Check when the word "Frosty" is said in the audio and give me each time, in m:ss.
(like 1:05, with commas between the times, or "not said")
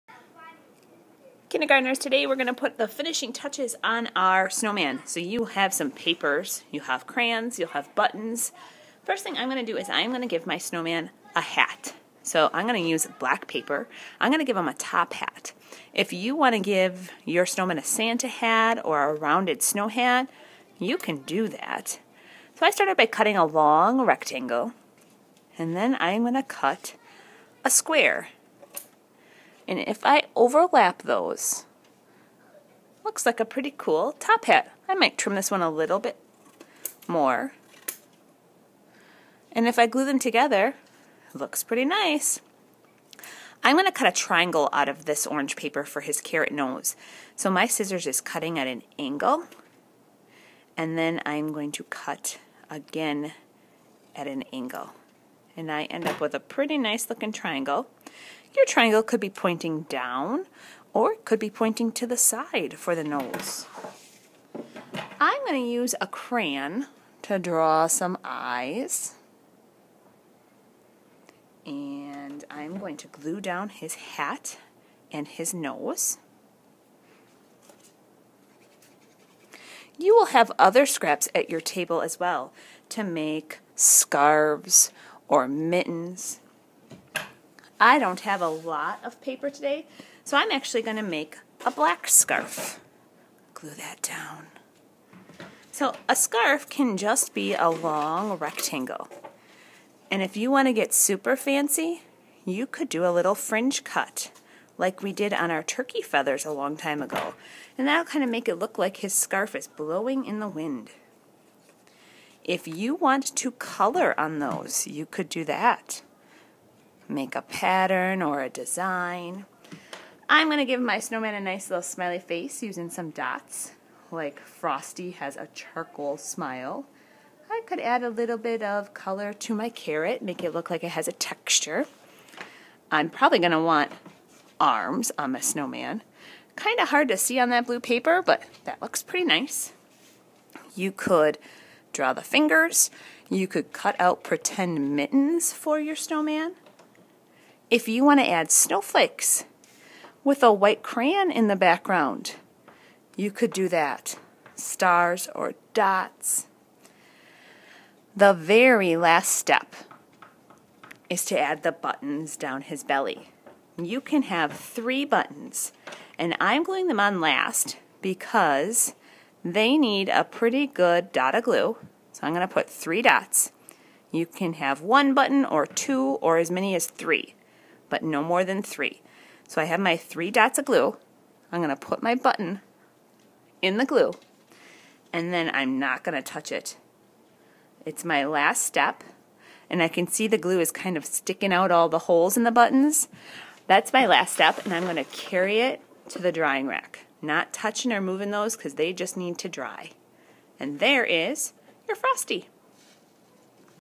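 2:04, 3:21.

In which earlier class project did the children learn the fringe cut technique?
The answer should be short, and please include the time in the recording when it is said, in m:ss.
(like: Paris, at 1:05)
turkey feathers, at 1:45.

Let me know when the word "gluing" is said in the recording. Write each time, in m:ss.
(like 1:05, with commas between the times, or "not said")
2:46.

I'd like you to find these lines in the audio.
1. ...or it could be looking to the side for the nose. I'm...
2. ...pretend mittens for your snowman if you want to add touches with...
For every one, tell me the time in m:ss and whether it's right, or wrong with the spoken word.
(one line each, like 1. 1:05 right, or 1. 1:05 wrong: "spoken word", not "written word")
1. 1:00 wrong: "pointing", not "looking"
2. 2:24 wrong: "snowflakes", not "touches".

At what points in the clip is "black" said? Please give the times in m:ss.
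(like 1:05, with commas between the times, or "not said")
0:13, 1:31.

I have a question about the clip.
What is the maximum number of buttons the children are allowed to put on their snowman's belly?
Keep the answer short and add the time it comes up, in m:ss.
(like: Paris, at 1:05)
3, at 2:58.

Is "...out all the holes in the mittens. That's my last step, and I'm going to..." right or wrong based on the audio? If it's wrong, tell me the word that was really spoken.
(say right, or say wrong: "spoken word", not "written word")
wrong: "buttons", not "mittens".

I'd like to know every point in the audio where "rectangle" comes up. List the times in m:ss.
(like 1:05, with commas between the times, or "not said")
0:23, 1:38.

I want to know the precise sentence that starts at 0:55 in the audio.
And I end up with a pretty nice looking triangle.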